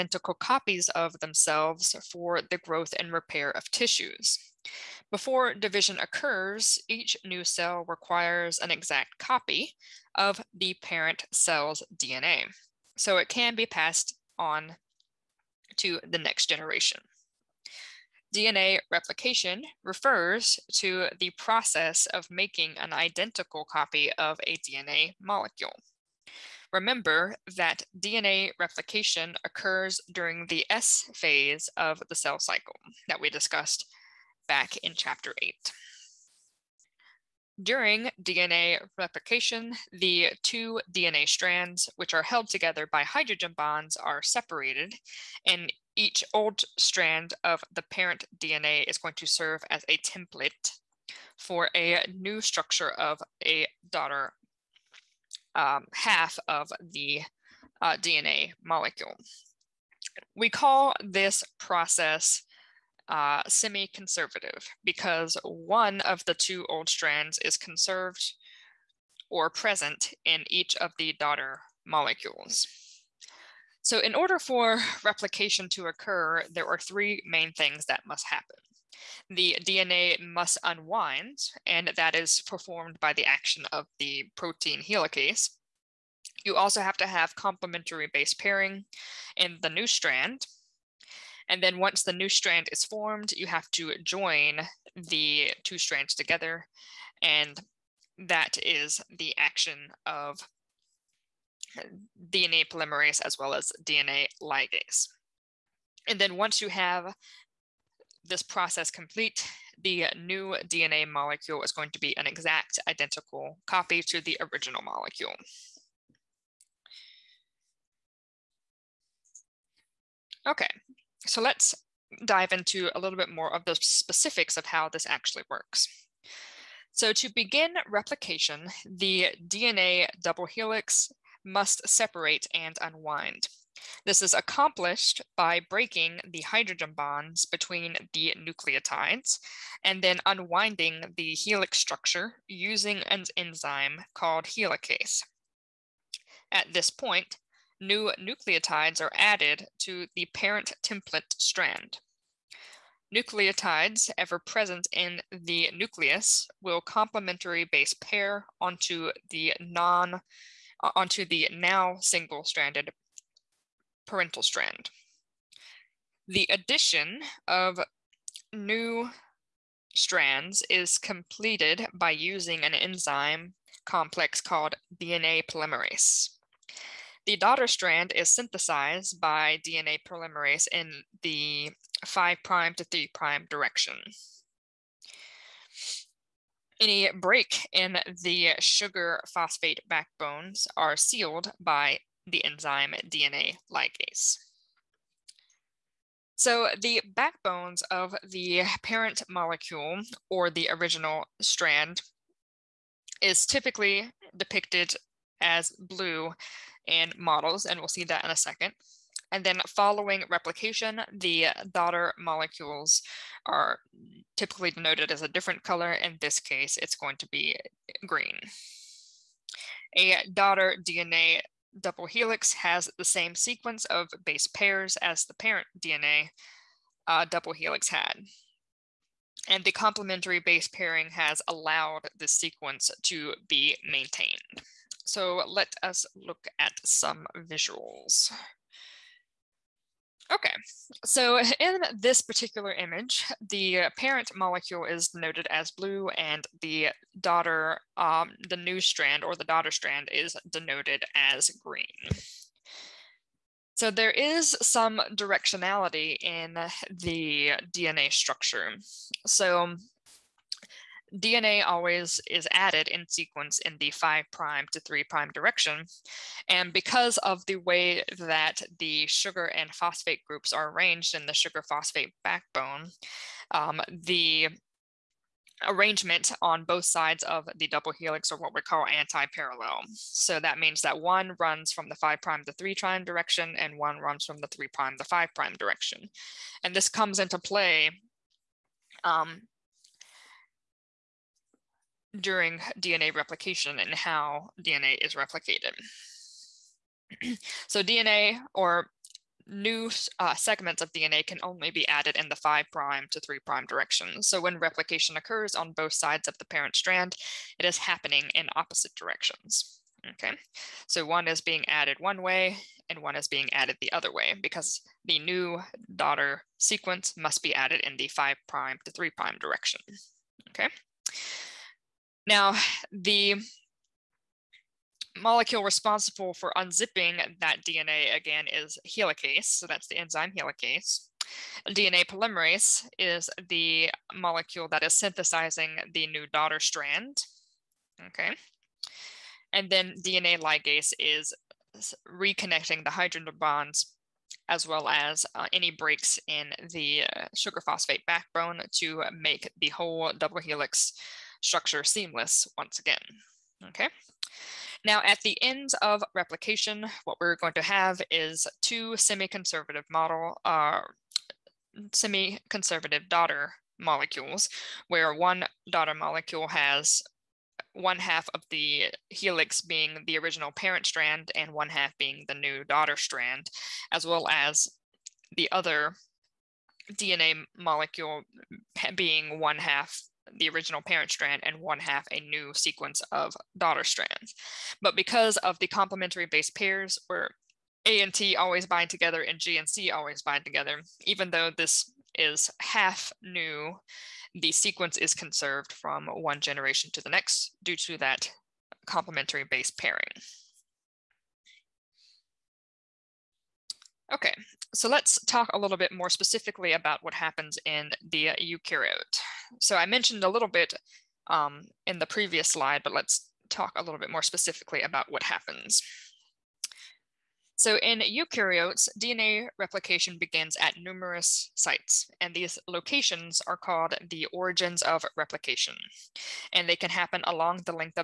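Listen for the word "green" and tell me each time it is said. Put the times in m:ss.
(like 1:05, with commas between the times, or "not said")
3:38, 4:11.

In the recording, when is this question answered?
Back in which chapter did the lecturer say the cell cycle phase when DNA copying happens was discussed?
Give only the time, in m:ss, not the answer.
0:34.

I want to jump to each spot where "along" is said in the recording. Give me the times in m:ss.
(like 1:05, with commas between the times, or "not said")
7:07.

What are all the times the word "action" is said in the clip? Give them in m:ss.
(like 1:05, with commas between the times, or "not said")
1:23, 1:39.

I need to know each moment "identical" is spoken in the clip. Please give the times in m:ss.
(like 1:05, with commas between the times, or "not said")
0:22, 1:52.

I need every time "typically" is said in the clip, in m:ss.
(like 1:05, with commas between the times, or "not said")
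3:23, 3:34.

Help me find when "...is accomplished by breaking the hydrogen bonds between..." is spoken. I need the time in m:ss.
2:14.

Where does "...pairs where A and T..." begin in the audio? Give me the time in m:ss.
6:26.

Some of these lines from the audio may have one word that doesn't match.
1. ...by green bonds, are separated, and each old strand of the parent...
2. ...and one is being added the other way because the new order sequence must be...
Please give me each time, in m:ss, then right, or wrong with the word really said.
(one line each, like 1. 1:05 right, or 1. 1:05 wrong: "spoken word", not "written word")
1. 0:42 wrong: "hydrogen", not "green"
2. 5:12 wrong: "daughter", not "order".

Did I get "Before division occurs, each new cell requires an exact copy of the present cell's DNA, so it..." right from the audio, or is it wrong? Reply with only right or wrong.
wrong.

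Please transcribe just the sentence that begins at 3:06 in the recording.
Any break in the sugar phosphate backbones are sealed by the enzyme DNA ligase.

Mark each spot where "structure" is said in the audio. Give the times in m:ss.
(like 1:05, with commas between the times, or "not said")
0:52, 2:21, 4:18, 5:51.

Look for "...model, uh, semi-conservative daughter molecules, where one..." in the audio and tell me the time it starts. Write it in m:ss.
5:59.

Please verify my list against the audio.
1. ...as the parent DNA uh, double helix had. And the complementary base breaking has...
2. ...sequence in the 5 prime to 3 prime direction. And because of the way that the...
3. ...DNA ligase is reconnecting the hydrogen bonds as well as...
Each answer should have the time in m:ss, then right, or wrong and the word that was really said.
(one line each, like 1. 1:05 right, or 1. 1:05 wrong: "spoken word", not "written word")
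1. 3:44 wrong: "pairing", not "breaking"
2. 4:23 right
3. 5:40 right.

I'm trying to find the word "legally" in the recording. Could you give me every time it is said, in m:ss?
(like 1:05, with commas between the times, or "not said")
not said.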